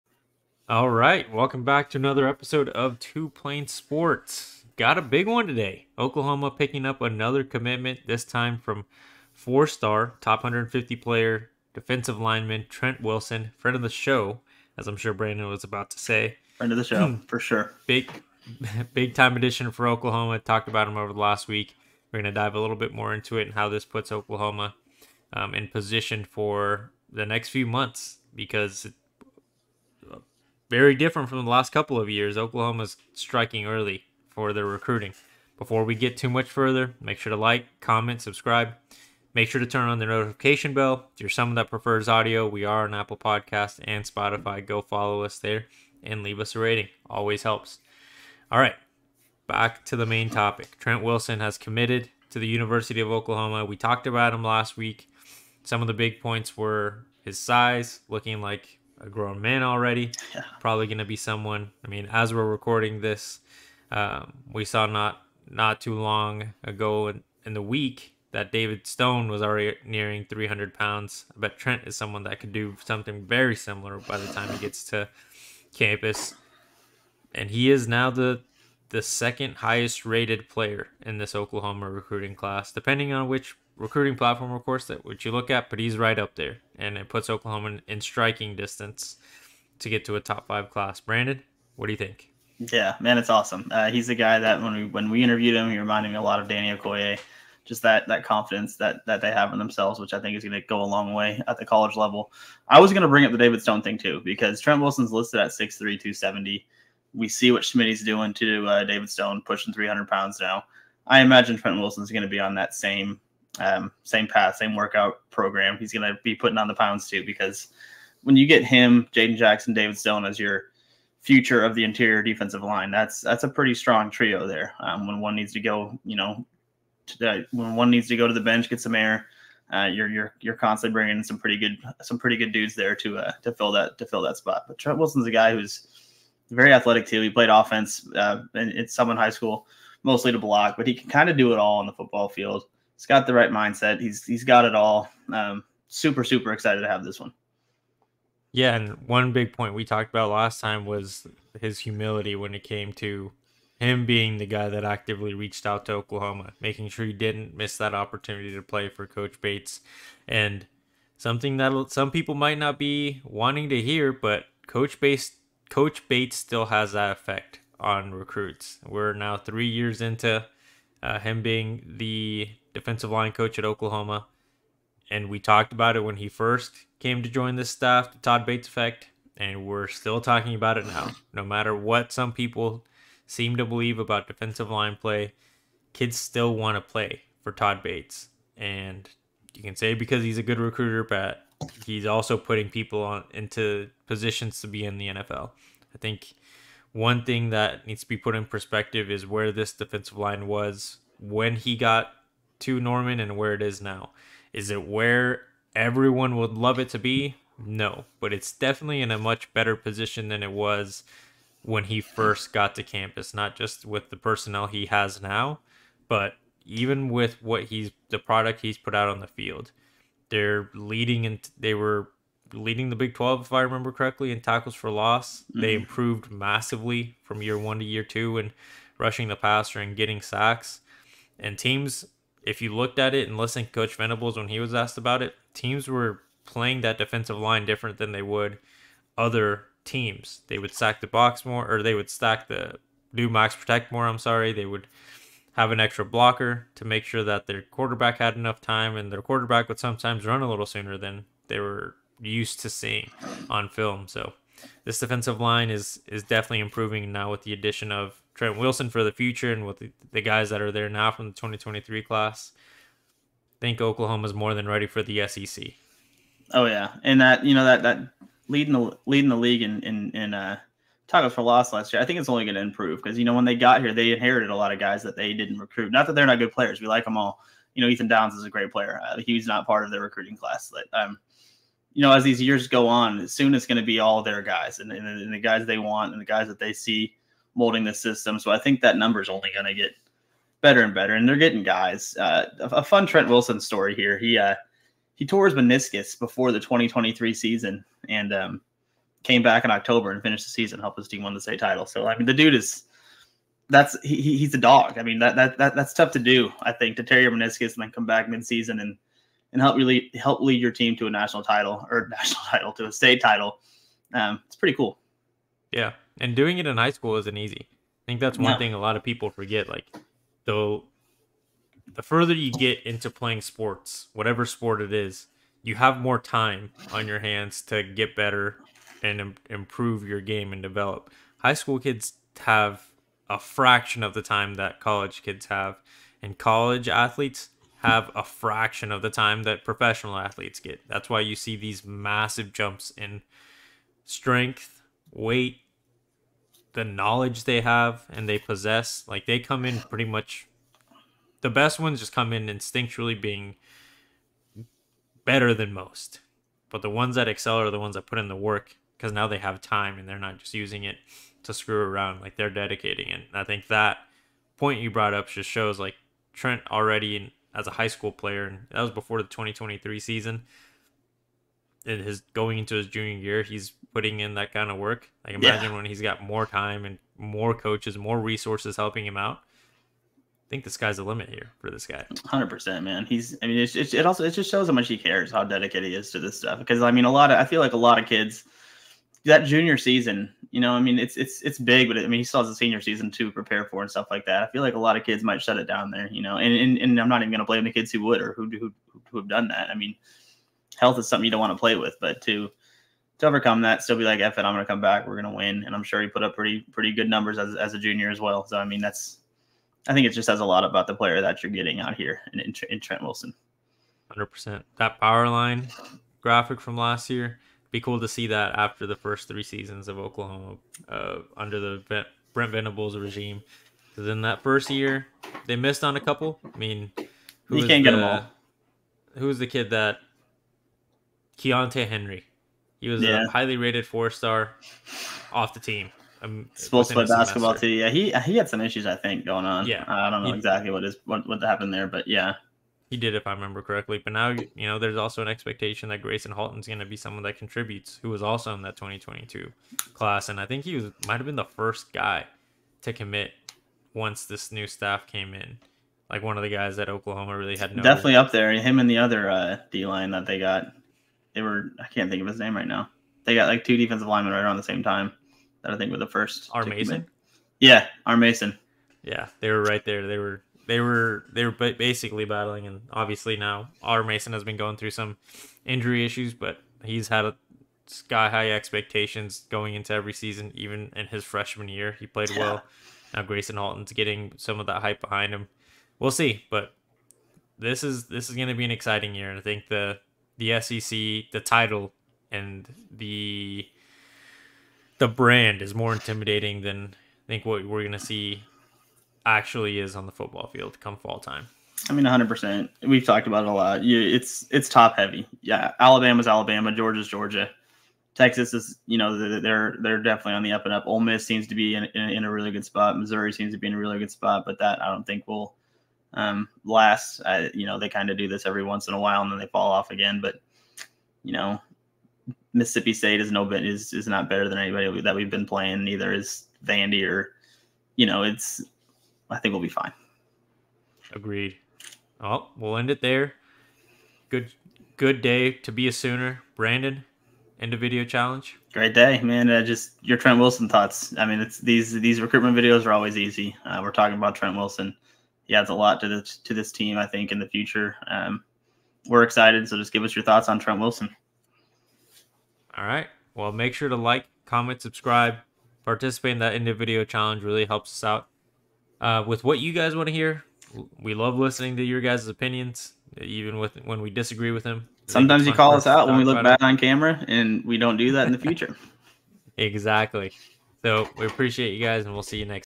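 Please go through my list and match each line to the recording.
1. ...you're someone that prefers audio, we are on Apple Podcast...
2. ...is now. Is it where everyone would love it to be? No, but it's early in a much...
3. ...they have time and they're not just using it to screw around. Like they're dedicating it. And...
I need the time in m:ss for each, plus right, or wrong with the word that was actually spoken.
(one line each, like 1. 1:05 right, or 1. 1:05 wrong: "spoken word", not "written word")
1. 0:41 right
2. 3:23 wrong: "definitely", not "early"
3. 5:59 right.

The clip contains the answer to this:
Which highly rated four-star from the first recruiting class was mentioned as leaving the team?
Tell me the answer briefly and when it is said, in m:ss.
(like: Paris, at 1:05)
Keontae Henry, at 7:11.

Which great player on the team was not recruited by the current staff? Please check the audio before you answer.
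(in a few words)
Ethan Downs.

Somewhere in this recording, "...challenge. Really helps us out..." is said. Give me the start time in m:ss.
9:17.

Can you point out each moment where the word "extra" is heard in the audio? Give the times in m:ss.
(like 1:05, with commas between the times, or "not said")
4:05.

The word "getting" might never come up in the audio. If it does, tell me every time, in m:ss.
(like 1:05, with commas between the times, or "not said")
3:49, 4:51, 6:51, 8:03.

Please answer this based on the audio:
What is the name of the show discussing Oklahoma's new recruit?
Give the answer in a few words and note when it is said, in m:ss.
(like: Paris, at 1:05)
Two Plane Sports, at 0:02.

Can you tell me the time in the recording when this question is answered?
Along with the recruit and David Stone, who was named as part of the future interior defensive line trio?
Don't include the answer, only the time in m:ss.
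1:59.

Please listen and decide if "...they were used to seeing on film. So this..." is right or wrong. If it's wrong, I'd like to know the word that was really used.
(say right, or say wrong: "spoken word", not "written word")
right.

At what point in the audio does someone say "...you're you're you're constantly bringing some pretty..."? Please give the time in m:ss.
2:09.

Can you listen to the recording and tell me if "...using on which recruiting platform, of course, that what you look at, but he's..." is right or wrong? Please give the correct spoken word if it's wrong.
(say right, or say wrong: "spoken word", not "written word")
wrong: "depending", not "using".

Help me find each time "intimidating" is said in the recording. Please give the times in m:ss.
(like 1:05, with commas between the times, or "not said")
8:15.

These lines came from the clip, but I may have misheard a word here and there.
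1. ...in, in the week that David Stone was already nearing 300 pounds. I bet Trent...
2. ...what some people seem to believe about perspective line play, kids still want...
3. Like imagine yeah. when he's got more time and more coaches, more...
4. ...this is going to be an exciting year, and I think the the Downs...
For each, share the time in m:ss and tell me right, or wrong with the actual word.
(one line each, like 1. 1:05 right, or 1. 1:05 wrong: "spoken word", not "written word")
1. 1:07 right
2. 3:01 wrong: "defensive", not "perspective"
3. 6:15 right
4. 8:08 wrong: "SEC", not "Downs".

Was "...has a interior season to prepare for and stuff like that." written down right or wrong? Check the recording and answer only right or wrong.
wrong.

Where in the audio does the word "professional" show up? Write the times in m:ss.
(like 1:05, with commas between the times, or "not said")
5:39.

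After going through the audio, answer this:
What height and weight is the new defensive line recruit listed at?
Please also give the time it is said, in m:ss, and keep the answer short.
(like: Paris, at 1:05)
6'3", 270, at 1:45.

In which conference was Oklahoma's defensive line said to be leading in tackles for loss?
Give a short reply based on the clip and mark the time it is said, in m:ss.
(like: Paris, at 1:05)
Big 12, at 3:42.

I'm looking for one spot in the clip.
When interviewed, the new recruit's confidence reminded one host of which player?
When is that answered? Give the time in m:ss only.
1:36.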